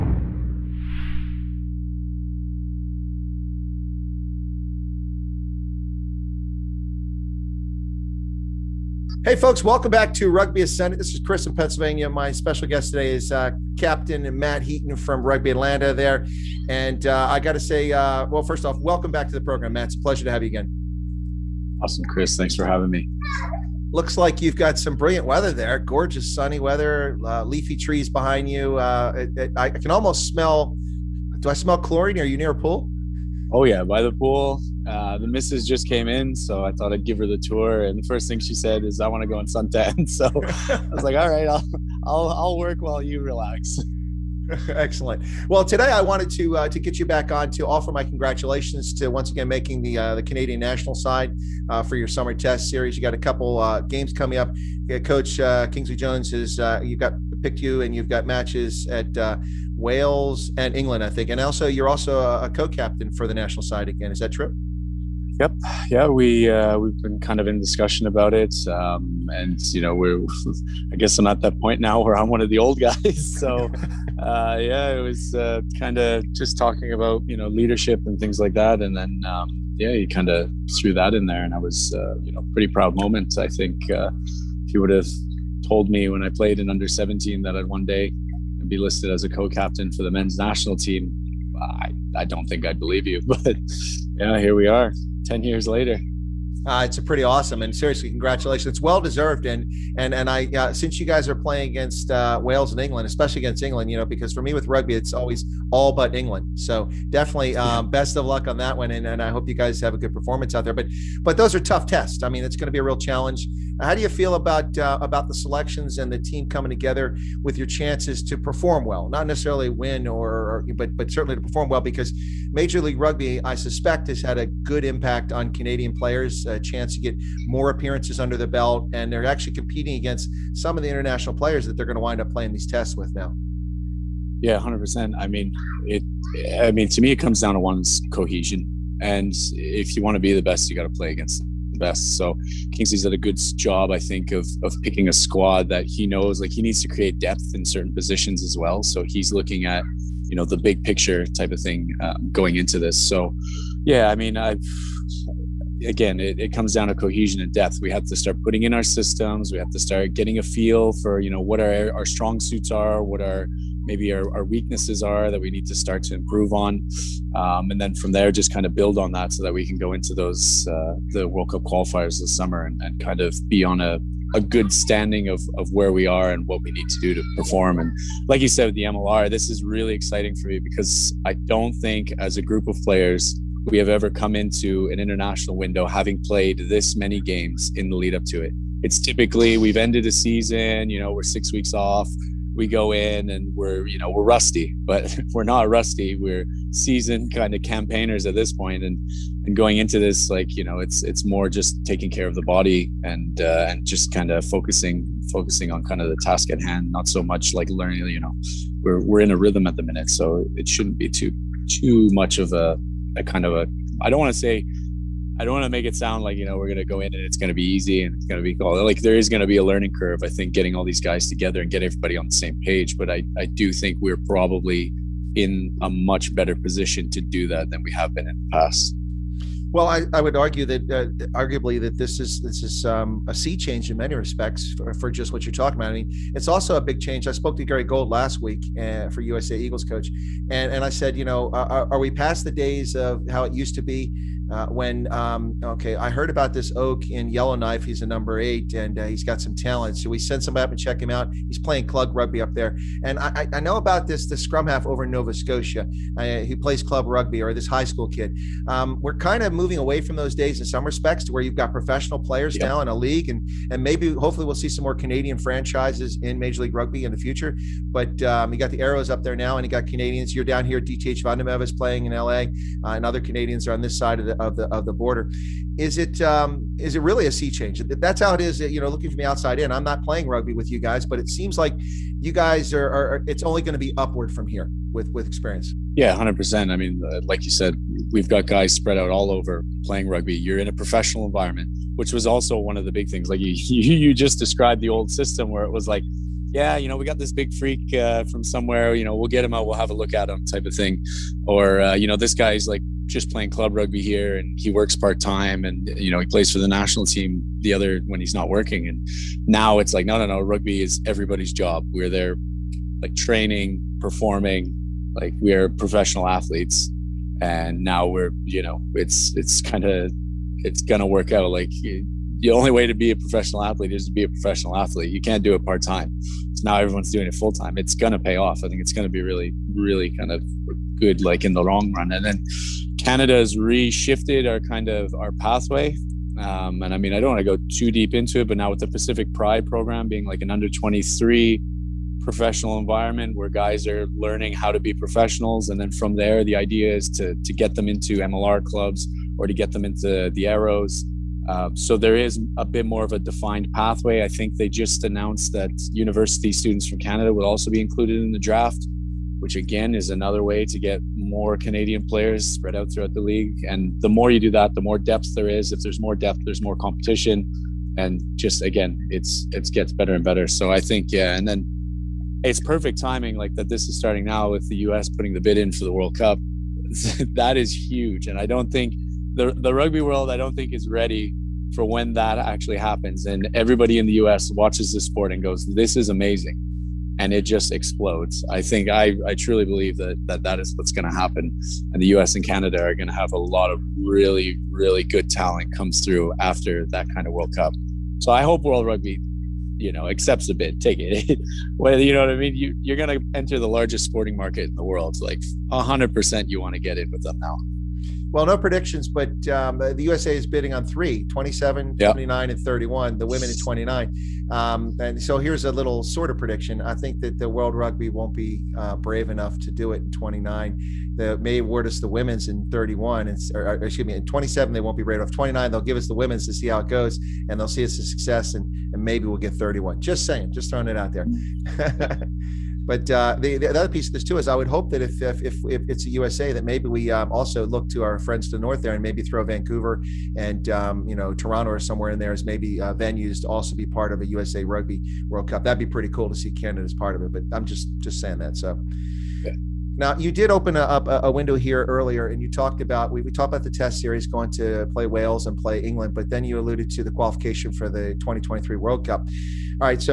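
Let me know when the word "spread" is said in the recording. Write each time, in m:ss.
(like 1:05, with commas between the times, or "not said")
4:48, 6:02.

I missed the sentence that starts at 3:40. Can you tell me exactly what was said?
I think getting all these guys together and get everybody on the same page.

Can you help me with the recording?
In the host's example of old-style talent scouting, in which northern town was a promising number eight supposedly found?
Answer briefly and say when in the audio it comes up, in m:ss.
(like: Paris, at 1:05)
Yellowknife, at 4:07.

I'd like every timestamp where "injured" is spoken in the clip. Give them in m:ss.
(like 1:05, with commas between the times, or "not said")
not said.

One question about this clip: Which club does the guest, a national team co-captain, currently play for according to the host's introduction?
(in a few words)
Rugby Atlanta.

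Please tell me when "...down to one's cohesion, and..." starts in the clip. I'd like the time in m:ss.
2:17.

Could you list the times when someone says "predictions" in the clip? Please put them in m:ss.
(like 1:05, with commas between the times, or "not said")
6:48, 6:56.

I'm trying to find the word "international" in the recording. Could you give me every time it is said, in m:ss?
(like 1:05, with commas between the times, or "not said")
2:10, 3:04.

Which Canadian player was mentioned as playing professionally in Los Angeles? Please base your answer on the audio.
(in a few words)
DTH van der Merwe.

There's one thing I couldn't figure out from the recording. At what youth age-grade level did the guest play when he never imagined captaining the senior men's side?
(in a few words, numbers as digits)
Under 17.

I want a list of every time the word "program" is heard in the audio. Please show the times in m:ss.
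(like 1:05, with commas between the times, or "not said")
0:19, 5:39.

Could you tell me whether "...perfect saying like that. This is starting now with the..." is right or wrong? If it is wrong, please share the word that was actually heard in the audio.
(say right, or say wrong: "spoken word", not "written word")
wrong: "timing", not "saying".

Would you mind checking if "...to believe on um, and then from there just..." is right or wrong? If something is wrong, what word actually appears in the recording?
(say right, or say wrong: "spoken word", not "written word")
wrong: "improve", not "believe".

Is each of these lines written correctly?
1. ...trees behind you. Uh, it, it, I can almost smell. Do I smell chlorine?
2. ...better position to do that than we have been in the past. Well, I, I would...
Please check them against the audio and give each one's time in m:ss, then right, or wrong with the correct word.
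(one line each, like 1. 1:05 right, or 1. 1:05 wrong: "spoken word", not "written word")
1. 0:27 right
2. 3:46 right.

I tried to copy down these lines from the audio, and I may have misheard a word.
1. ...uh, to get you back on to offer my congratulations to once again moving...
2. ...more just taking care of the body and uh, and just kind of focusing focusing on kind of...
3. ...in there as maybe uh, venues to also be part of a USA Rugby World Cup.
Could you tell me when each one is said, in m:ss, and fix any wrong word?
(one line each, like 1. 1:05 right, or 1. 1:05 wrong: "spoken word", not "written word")
1. 0:46 wrong: "making", not "moving"
2. 3:21 right
3. 7:22 right.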